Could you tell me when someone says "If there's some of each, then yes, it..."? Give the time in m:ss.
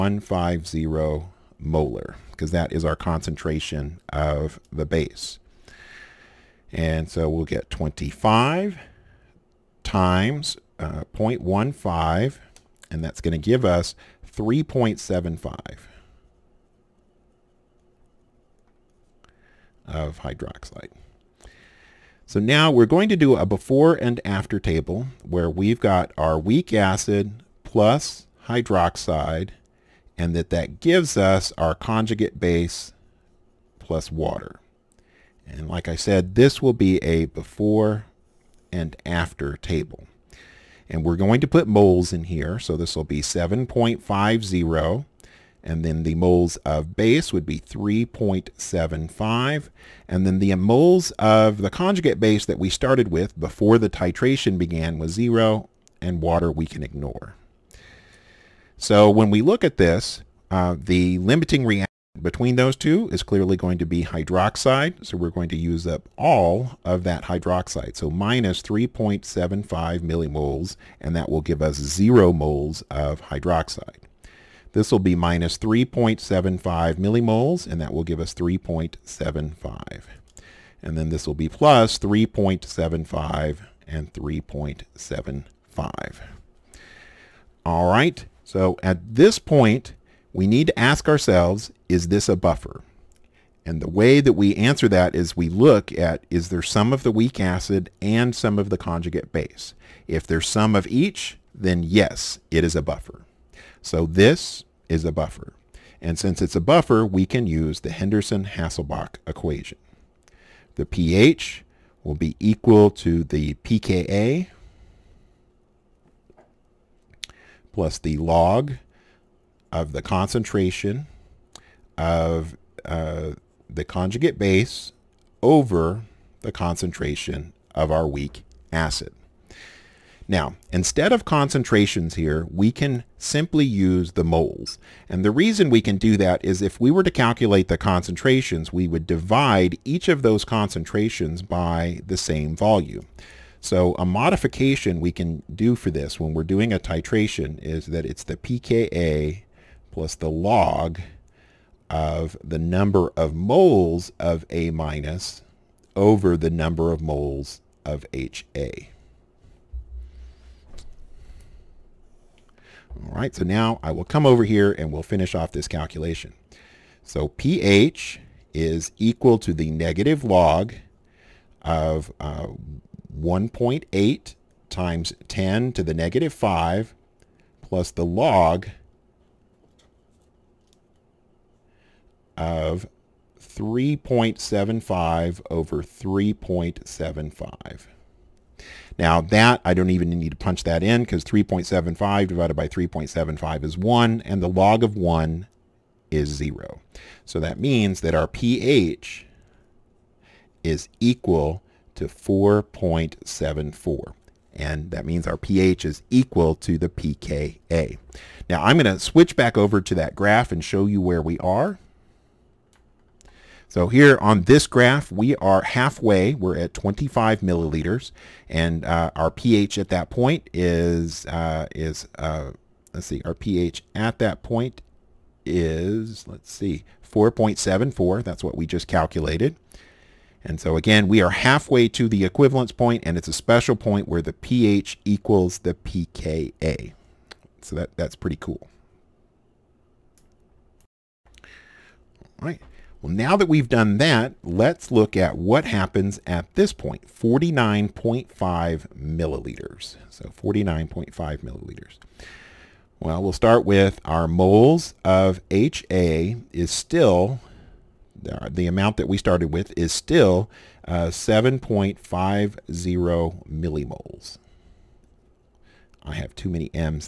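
1:40.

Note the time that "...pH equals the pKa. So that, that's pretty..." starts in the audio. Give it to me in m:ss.
3:54.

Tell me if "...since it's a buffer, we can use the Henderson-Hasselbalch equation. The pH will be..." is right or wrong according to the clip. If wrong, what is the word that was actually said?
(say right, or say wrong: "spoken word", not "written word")
right.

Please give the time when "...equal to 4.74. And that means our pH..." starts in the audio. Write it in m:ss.
3:21.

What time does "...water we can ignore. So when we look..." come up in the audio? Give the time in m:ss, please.
0:56.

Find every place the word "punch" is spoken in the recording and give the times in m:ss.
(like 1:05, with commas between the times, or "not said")
3:10.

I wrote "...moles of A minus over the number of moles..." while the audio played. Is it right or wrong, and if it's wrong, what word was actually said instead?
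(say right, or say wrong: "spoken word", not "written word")
right.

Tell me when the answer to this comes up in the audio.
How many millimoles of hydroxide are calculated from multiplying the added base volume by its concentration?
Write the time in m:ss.
0:14.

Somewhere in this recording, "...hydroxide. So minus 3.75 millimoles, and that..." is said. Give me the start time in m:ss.
1:07.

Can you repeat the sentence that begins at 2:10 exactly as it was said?
Now, instead of concentrations here, we can simply use the moles.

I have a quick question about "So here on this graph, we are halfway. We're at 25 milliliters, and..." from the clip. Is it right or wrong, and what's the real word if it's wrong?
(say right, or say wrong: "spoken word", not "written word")
right.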